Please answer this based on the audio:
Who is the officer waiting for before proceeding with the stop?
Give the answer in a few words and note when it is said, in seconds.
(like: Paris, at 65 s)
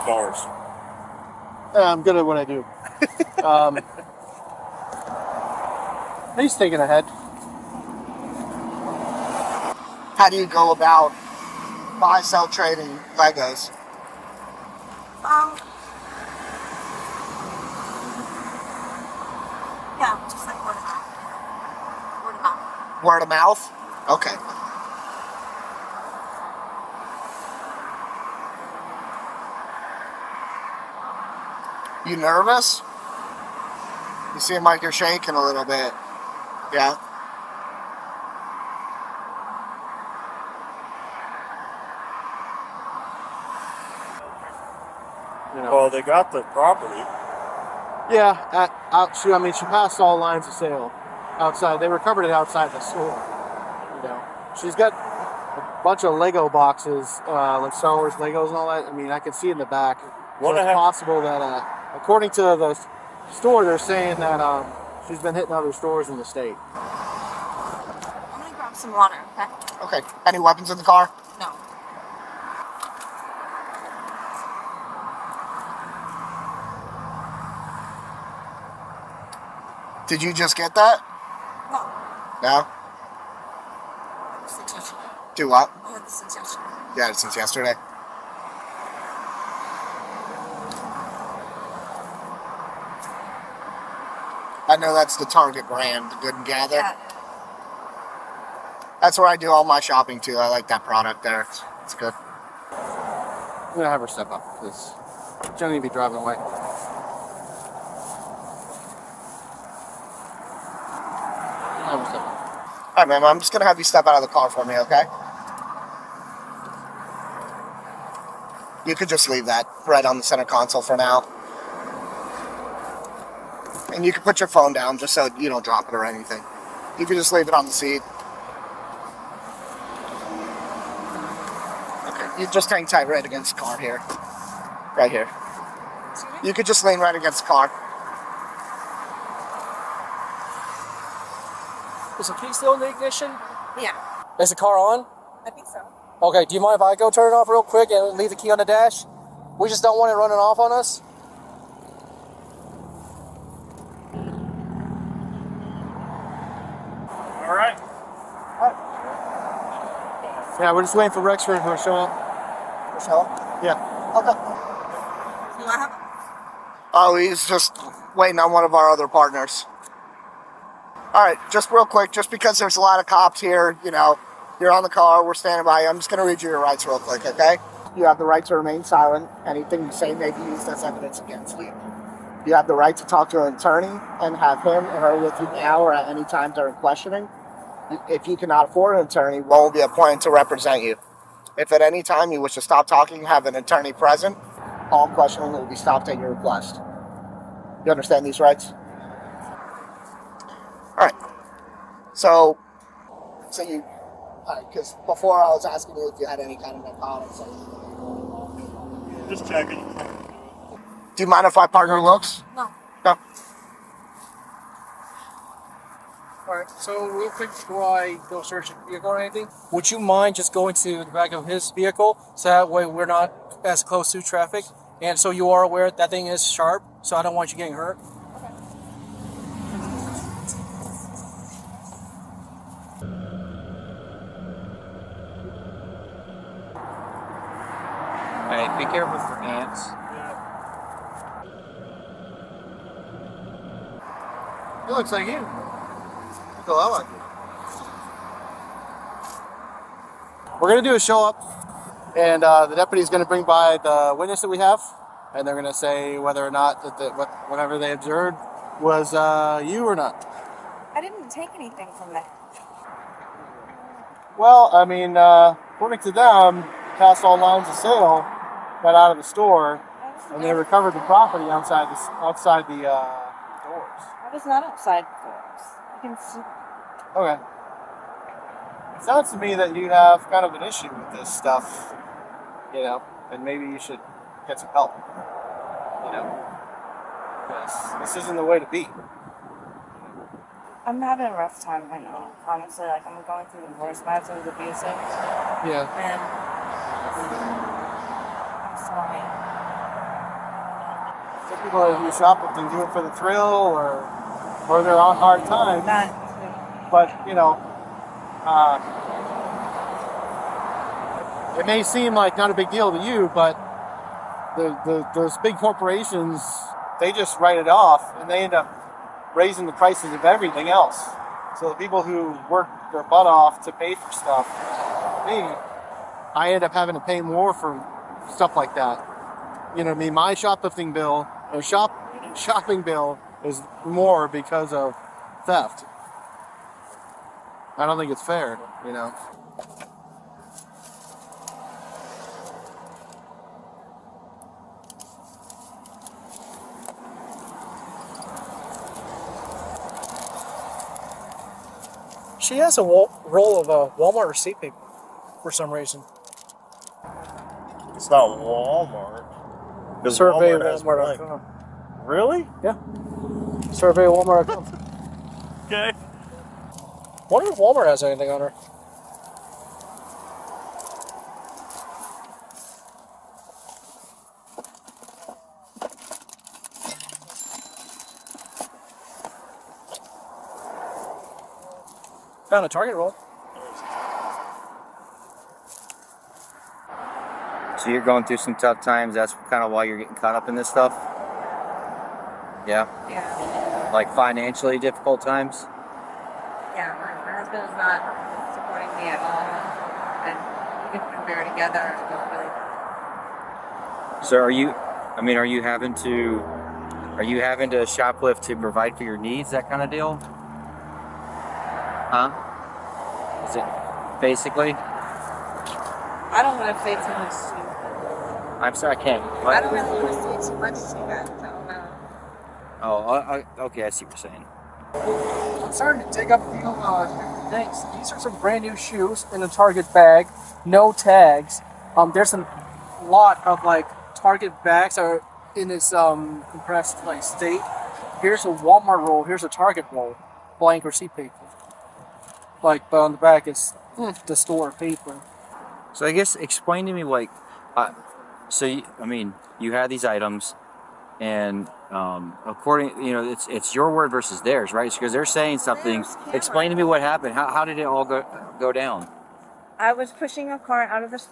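Rex Room, at 161 s.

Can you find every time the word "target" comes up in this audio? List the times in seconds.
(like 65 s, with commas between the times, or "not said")
95 s, 382 s, 429 s, 434 s, 439 s.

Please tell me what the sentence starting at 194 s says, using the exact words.
All questioning will be stopped at your request.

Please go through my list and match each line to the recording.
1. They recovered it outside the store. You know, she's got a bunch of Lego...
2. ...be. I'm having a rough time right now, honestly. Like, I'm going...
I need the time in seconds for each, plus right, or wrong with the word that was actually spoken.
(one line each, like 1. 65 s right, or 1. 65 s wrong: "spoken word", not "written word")
1. 51 s right
2. 288 s right.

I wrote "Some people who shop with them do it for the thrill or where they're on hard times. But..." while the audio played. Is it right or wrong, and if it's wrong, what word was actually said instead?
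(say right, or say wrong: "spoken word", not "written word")
right.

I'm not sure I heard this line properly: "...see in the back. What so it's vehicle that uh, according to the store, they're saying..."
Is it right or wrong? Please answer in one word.
wrong.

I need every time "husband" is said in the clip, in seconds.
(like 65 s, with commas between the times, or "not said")
294 s, 397 s.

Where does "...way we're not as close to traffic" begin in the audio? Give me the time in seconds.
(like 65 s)
222 s.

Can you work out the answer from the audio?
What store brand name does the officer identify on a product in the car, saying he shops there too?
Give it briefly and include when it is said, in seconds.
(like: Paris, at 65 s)
Good and Gather, at 96 s.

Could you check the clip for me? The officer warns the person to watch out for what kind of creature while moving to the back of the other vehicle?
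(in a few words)
Ants.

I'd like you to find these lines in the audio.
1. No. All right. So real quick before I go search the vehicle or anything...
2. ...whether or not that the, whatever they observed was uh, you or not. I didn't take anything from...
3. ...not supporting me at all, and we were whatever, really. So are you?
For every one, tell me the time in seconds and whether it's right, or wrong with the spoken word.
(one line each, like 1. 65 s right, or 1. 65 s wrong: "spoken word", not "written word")
1. 212 s right
2. 256 s right
3. 397 s wrong: "together", not "whatever".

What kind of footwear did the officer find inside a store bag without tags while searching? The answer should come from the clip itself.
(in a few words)
Brand new shoes.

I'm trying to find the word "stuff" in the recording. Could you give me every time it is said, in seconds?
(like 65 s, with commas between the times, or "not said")
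281 s, 324 s, 328 s, 390 s.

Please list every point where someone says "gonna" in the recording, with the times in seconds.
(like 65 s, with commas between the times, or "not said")
67 s, 103 s, 113 s.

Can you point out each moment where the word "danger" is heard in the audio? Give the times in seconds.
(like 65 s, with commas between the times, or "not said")
not said.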